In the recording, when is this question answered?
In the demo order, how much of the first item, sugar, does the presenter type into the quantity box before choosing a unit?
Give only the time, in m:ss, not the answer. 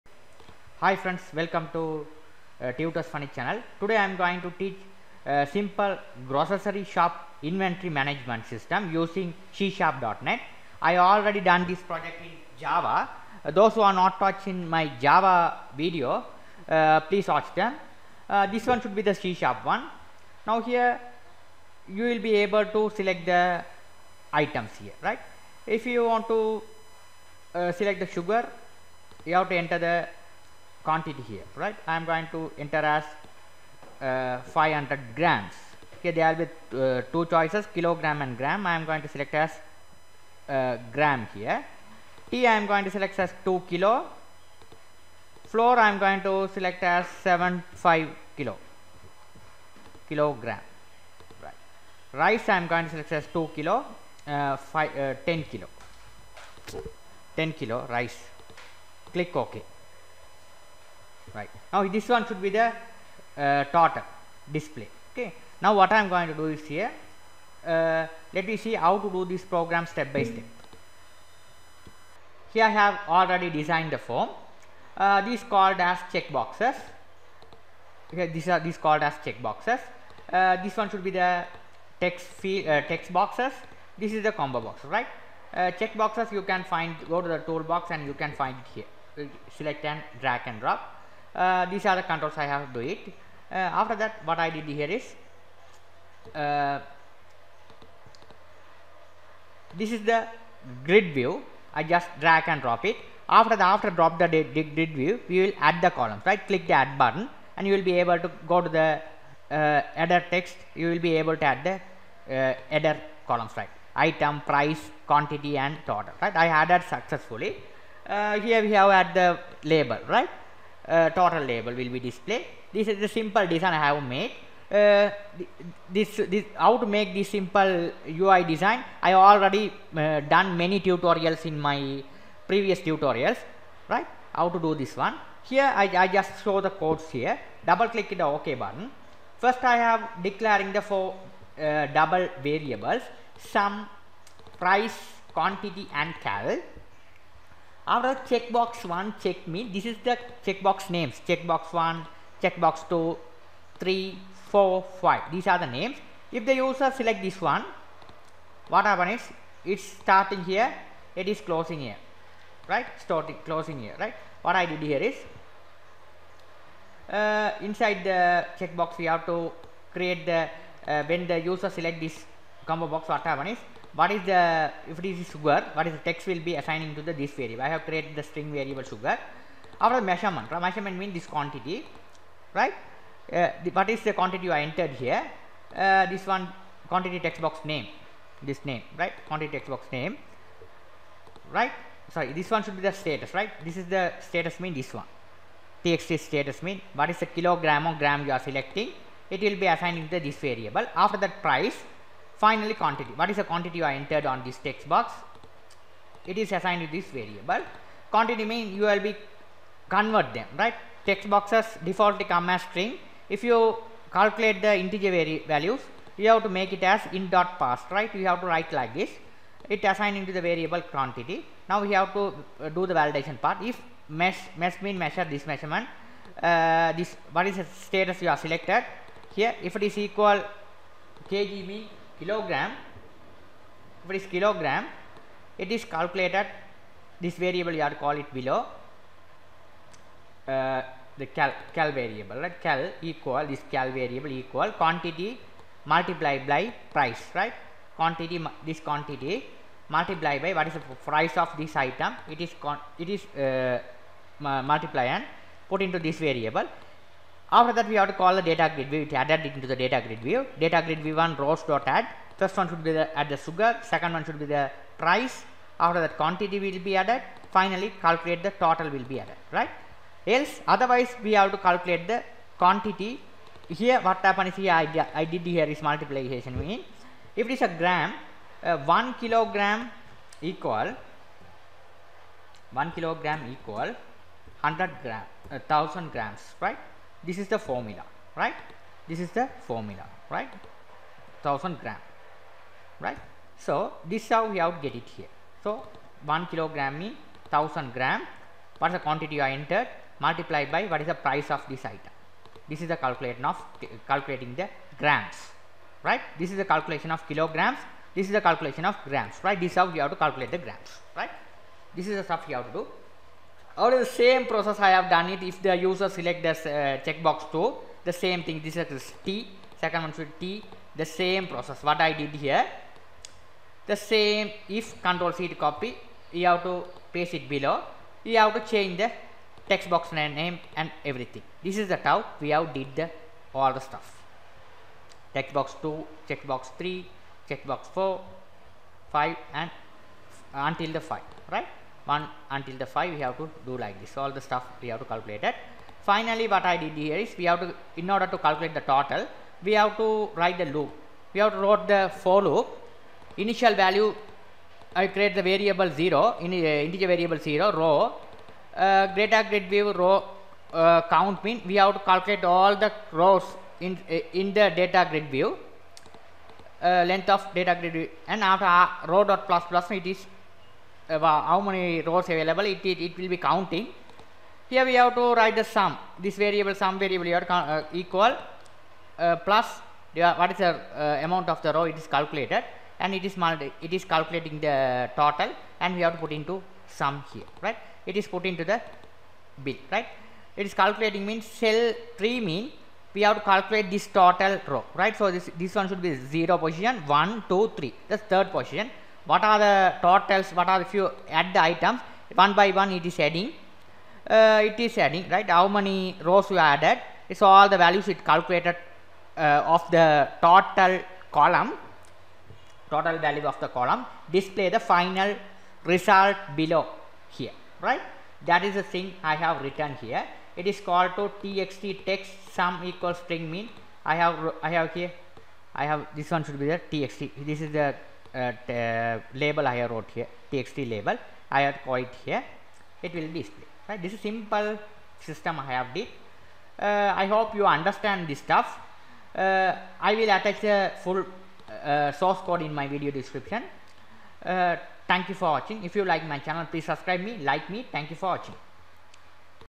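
0:34.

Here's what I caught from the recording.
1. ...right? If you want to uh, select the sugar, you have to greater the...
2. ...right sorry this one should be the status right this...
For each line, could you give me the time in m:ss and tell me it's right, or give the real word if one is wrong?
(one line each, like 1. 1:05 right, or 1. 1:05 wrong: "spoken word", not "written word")
1. 0:25 wrong: "enter", not "greater"
2. 3:11 right.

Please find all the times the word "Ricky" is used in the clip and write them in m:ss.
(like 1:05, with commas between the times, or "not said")
not said.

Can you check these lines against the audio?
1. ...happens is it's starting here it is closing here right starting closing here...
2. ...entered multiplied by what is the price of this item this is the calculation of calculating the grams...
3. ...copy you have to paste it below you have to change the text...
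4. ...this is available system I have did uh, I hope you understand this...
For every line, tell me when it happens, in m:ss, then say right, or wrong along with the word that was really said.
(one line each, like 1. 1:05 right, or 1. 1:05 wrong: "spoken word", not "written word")
1. 2:38 right
2. 4:59 right
3. 5:25 right
4. 7:14 wrong: "simple", not "available".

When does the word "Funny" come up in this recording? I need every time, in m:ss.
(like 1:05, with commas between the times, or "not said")
0:03.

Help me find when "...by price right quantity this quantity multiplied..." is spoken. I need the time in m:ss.
4:06.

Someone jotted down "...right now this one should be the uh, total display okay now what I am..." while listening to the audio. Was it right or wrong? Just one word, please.
right.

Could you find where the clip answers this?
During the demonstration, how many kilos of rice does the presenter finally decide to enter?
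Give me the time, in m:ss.
0:57.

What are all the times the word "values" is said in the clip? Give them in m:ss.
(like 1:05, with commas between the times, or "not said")
3:35, 5:53, 6:47, 6:53.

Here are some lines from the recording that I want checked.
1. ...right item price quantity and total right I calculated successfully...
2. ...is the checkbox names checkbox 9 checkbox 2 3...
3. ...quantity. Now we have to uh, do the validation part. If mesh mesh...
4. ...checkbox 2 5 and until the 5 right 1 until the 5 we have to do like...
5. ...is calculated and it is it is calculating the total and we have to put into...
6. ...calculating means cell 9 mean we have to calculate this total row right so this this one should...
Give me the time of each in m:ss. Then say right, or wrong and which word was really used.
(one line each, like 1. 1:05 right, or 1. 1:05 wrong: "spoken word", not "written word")
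1. 1:53 wrong: "added", not "calculated"
2. 2:29 wrong: "1", not "9"
3. 3:40 right
4. 5:37 wrong: "4", not "2"
5. 6:22 right
6. 6:30 wrong: "3", not "9".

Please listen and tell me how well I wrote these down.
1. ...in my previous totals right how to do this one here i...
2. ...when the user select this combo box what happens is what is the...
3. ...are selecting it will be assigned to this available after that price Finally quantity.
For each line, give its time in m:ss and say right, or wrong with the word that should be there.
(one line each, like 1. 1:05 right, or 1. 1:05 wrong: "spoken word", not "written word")
1. 2:11 wrong: "tutorials", not "totals"
2. 2:51 right
3. 3:18 wrong: "variable", not "available".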